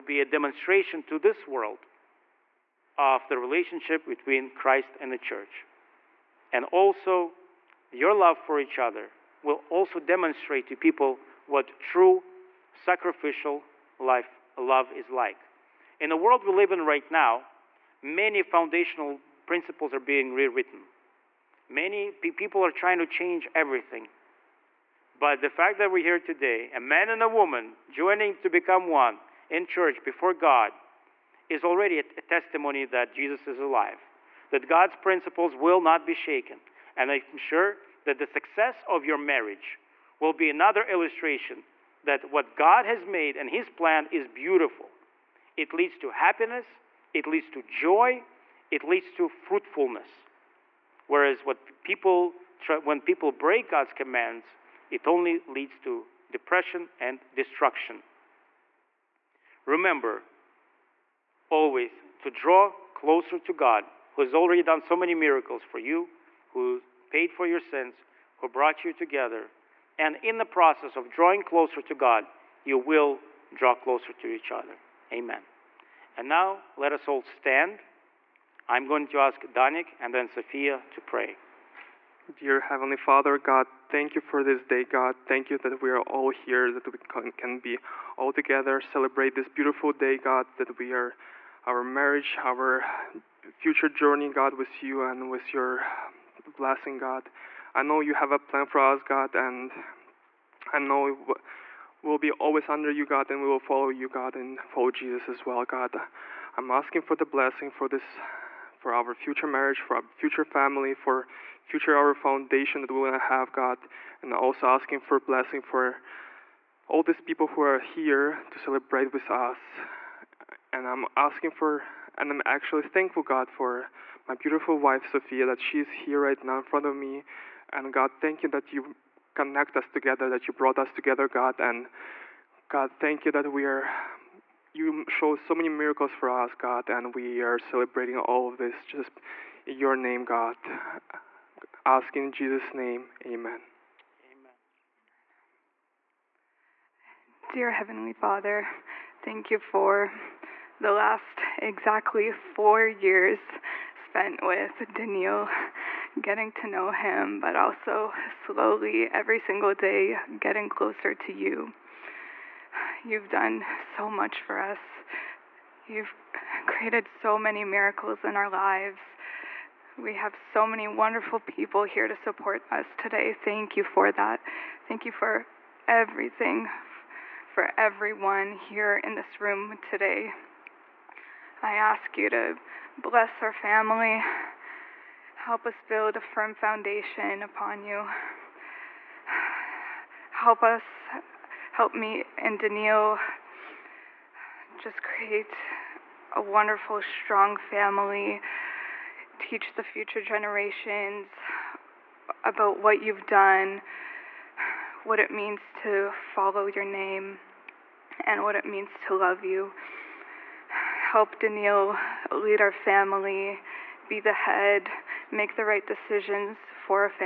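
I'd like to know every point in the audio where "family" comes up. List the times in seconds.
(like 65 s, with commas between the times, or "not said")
110 s, 183 s, 197 s, 212 s.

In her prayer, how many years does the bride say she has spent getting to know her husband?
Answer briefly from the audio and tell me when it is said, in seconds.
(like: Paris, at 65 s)
4, at 152 s.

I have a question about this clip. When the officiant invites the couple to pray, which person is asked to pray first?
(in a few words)
Danik.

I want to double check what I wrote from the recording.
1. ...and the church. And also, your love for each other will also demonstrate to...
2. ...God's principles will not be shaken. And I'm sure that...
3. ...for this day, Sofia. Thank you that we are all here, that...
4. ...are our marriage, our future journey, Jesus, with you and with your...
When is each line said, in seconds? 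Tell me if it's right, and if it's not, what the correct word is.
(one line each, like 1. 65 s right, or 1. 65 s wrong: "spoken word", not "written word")
1. 4 s right
2. 34 s right
3. 84 s wrong: "God", not "Sofia"
4. 90 s wrong: "God", not "Jesus".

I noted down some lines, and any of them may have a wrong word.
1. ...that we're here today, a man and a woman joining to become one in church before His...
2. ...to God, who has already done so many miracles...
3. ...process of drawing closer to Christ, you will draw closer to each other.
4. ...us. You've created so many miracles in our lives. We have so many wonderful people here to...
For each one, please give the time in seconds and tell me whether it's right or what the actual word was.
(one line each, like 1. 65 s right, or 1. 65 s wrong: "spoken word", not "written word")
1. 25 s wrong: "God", not "His"
2. 63 s right
3. 70 s wrong: "God", not "Christ"
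4. 164 s right.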